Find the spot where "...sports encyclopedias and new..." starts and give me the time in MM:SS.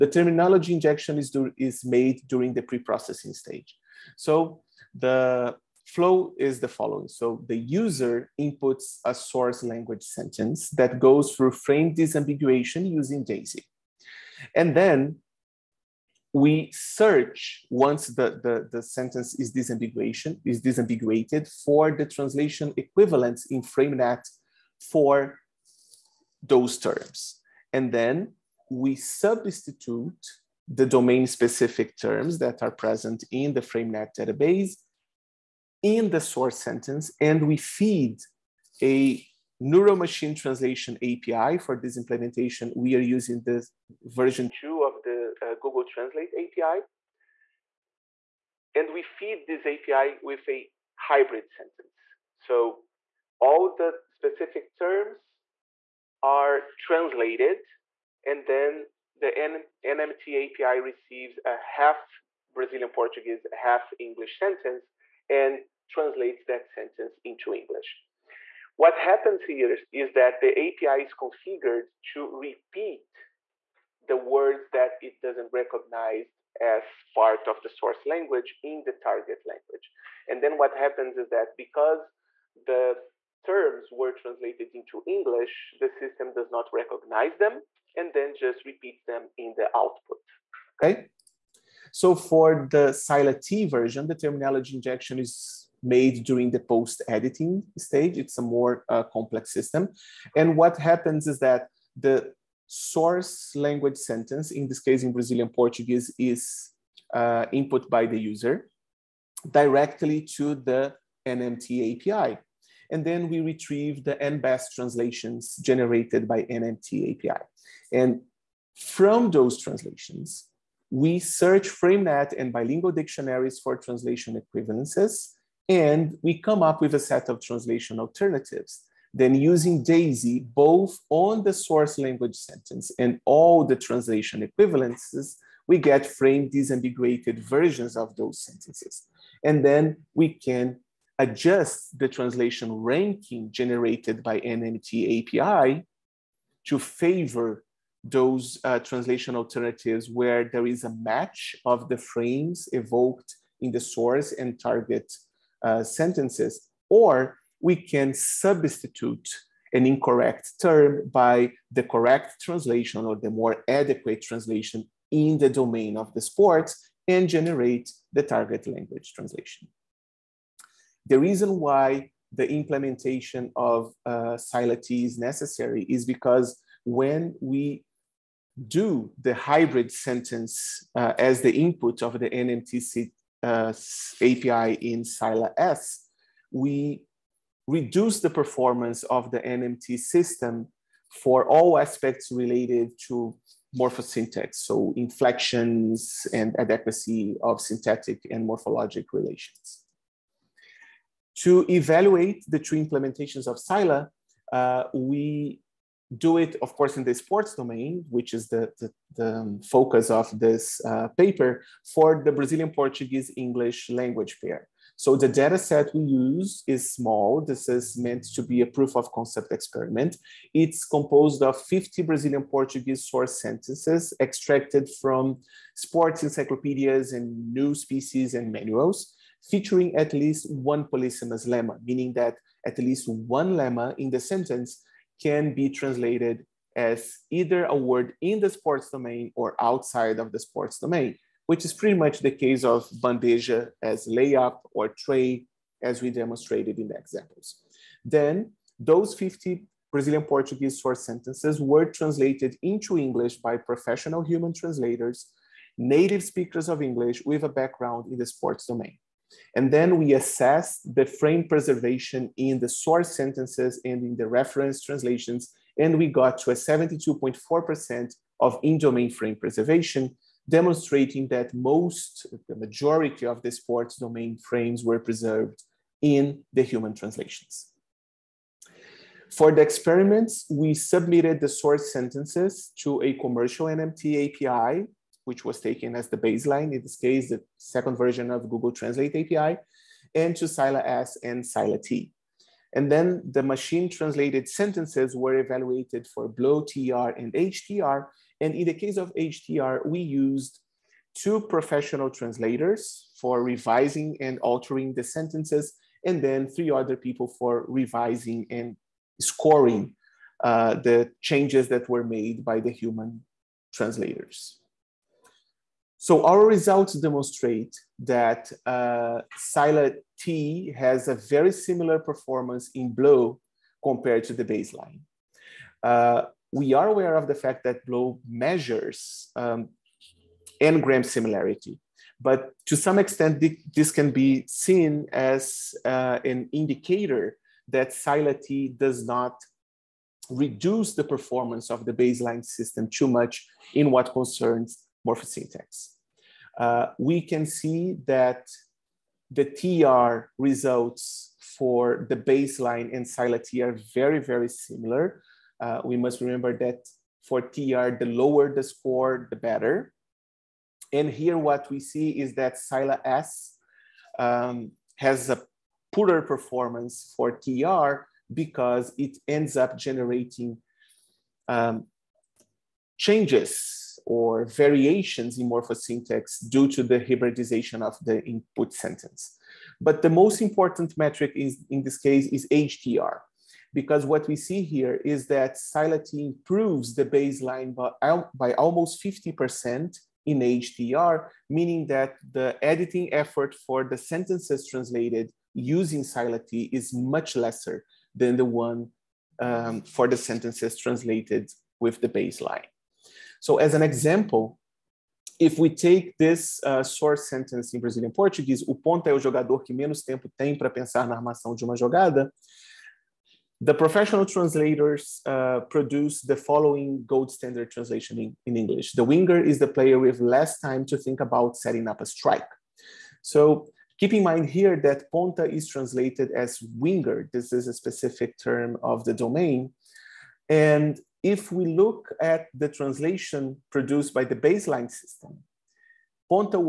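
03:45.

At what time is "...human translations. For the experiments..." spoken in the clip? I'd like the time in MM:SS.
04:36.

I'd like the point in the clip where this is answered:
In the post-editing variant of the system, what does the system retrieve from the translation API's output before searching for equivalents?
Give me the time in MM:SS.
01:54.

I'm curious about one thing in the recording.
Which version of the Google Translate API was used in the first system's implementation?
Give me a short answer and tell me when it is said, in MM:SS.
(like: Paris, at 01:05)
Version 2, at 00:44.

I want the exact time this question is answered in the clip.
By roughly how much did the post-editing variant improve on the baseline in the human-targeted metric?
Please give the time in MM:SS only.
06:28.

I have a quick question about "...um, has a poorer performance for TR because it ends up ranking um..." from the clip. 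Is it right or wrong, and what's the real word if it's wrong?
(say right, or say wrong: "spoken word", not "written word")
wrong: "generating", not "ranking".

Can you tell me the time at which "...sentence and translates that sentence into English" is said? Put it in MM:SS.
01:04.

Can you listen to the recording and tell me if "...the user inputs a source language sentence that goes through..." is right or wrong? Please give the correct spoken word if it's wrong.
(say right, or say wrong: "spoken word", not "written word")
right.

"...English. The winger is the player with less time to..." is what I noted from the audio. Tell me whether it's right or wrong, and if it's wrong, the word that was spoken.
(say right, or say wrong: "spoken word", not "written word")
right.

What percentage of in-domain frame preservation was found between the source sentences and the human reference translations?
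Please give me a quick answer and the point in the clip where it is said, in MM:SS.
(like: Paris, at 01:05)
72.4%, at 04:26.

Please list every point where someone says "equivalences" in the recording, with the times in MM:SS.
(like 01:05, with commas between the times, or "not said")
00:22, 02:04, 02:14.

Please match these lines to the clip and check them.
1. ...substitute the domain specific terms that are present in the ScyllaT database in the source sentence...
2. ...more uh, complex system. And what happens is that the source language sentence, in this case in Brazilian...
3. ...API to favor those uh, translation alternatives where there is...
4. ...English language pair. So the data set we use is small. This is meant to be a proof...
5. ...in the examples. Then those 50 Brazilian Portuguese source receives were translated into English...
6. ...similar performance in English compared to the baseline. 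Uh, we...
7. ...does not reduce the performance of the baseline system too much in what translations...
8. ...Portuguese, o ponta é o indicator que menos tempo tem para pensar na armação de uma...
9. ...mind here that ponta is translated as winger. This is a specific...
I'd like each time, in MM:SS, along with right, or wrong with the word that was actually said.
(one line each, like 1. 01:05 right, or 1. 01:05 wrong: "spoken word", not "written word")
1. 00:28 wrong: "FrameNet", not "ScyllaT"
2. 01:38 right
3. 02:25 right
4. 03:33 right
5. 04:06 wrong: "sentences", not "receives"
6. 05:21 wrong: "BLEU", not "English"
7. 05:38 wrong: "concerns", not "translations"
8. 06:48 wrong: "jogador", not "indicator"
9. 07:04 right.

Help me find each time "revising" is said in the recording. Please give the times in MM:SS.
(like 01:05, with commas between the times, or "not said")
05:03, 05:07.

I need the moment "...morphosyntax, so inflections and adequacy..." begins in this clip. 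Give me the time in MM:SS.
03:13.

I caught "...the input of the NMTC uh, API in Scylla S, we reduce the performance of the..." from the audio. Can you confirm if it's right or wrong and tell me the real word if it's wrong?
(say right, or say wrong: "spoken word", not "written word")
right.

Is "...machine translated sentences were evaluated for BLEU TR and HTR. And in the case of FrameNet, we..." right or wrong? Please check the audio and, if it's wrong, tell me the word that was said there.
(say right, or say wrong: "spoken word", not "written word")
wrong: "HTR", not "FrameNet".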